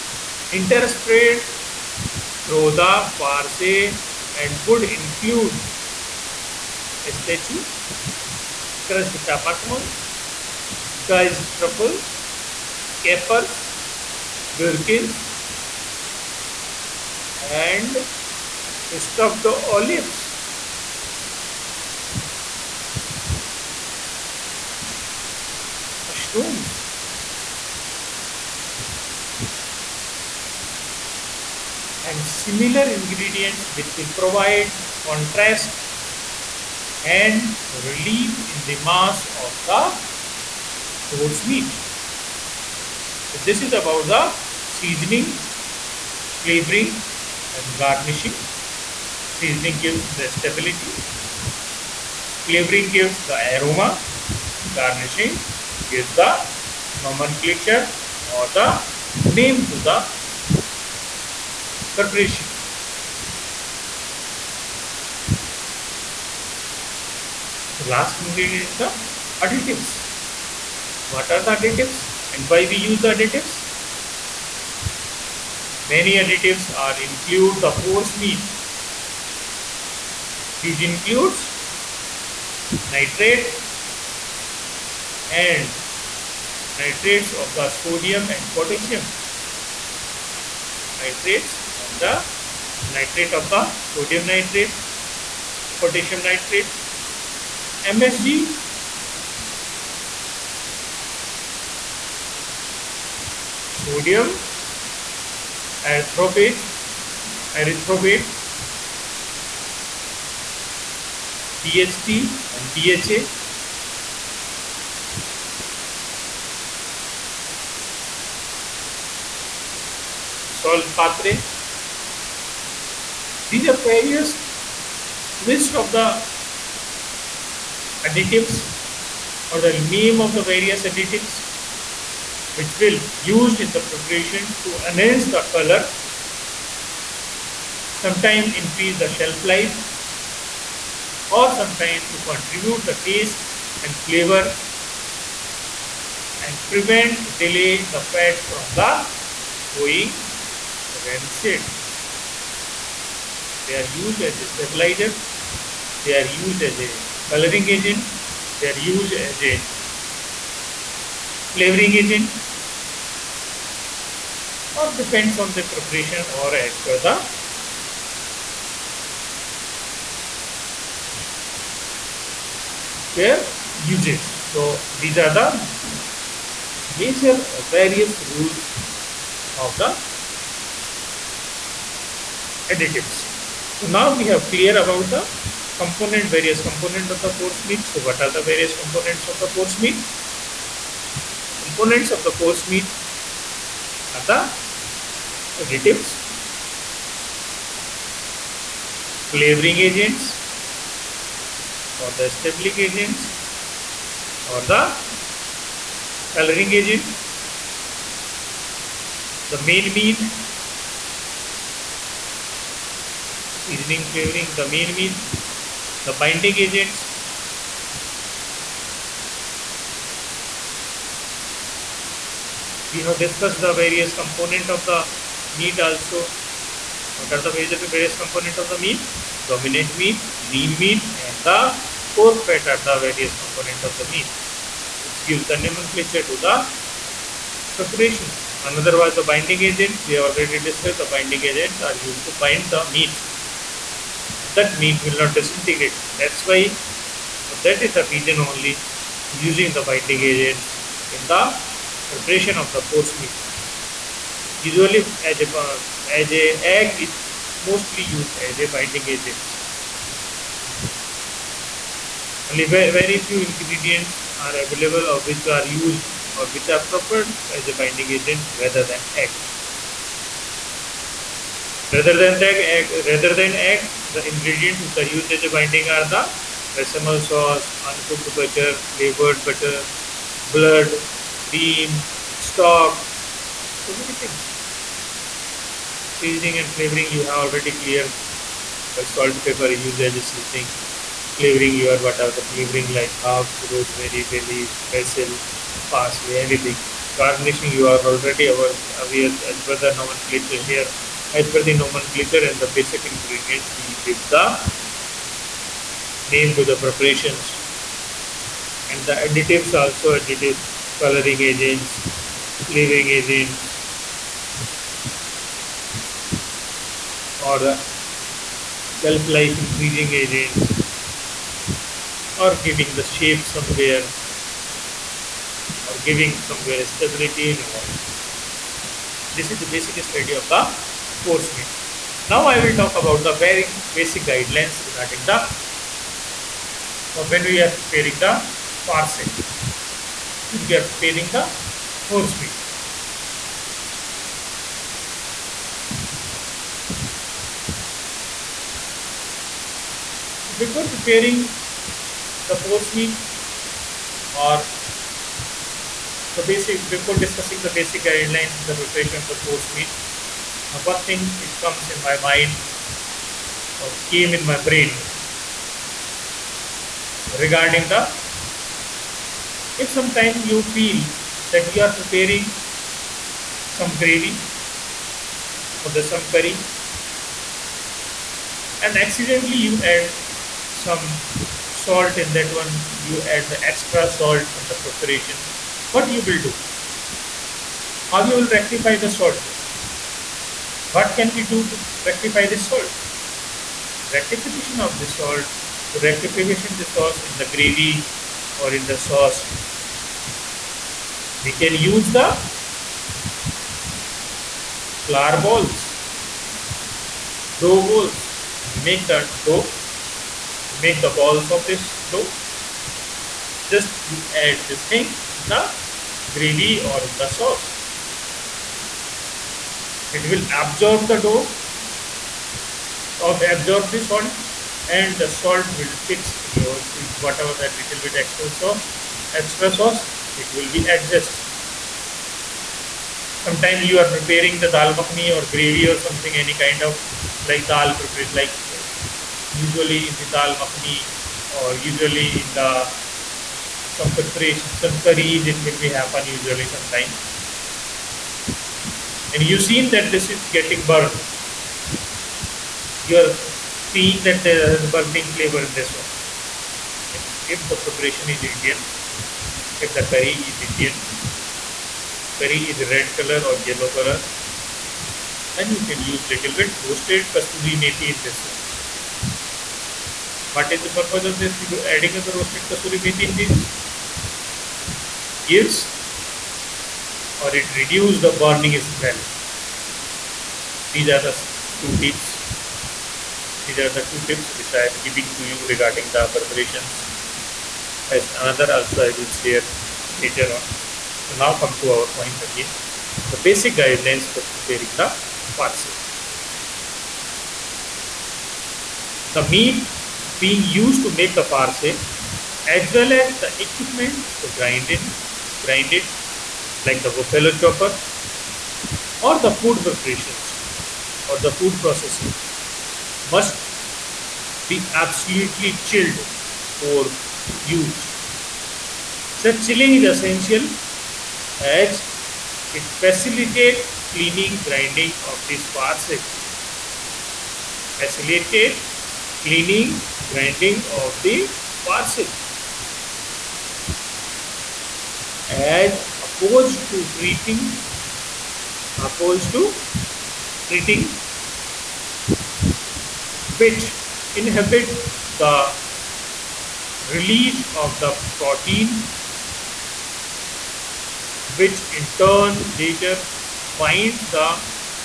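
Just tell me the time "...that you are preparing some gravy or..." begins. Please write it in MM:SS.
06:11.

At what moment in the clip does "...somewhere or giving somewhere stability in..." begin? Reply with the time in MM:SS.
05:23.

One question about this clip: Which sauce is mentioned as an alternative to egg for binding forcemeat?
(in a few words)
Bechamel sauce.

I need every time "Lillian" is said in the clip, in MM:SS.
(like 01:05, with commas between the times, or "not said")
not said.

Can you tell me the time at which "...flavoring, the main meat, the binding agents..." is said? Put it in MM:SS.
03:34.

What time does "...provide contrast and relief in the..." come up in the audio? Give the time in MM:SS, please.
00:34.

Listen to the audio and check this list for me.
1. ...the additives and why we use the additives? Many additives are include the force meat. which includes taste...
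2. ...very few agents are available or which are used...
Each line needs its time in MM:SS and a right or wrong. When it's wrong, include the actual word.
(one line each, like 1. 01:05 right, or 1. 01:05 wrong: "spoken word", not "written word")
1. 01:11 wrong: "nitrate", not "taste"
2. 04:22 wrong: "ingredients", not "agents".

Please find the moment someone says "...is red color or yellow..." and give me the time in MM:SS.
07:42.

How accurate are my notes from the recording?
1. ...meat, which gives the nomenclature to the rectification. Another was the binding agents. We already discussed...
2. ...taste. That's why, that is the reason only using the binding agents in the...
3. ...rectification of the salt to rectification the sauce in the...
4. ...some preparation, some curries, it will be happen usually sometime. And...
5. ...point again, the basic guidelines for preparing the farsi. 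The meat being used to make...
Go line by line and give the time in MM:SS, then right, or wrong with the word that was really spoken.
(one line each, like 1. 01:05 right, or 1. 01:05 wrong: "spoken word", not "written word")
1. 03:54 wrong: "preparation", not "rectification"
2. 04:05 wrong: "disintegrate", not "taste"
3. 06:34 right
4. 07:23 right
5. 08:12 right.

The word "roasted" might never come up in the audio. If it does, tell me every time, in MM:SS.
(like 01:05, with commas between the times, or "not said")
07:46, 07:52.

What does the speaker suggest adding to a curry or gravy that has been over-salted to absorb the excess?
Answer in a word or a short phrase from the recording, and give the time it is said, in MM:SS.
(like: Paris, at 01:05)
Dough balls, at 06:47.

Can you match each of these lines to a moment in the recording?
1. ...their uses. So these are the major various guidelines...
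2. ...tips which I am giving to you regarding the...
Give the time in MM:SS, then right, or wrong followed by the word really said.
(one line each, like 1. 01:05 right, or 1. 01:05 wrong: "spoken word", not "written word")
1. 02:53 wrong: "rules", not "guidelines"
2. 08:04 right.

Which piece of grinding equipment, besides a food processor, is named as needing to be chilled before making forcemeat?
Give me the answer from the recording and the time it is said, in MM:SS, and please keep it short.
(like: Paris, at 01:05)
Buffalo chopper, at 08:27.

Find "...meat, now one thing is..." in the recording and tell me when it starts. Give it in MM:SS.
05:59.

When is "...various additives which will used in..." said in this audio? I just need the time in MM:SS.
02:10.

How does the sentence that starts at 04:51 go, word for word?
Flavoring, you are what are the flavoring like herbs, rosemary, bay leaf, basil, parsley, anything.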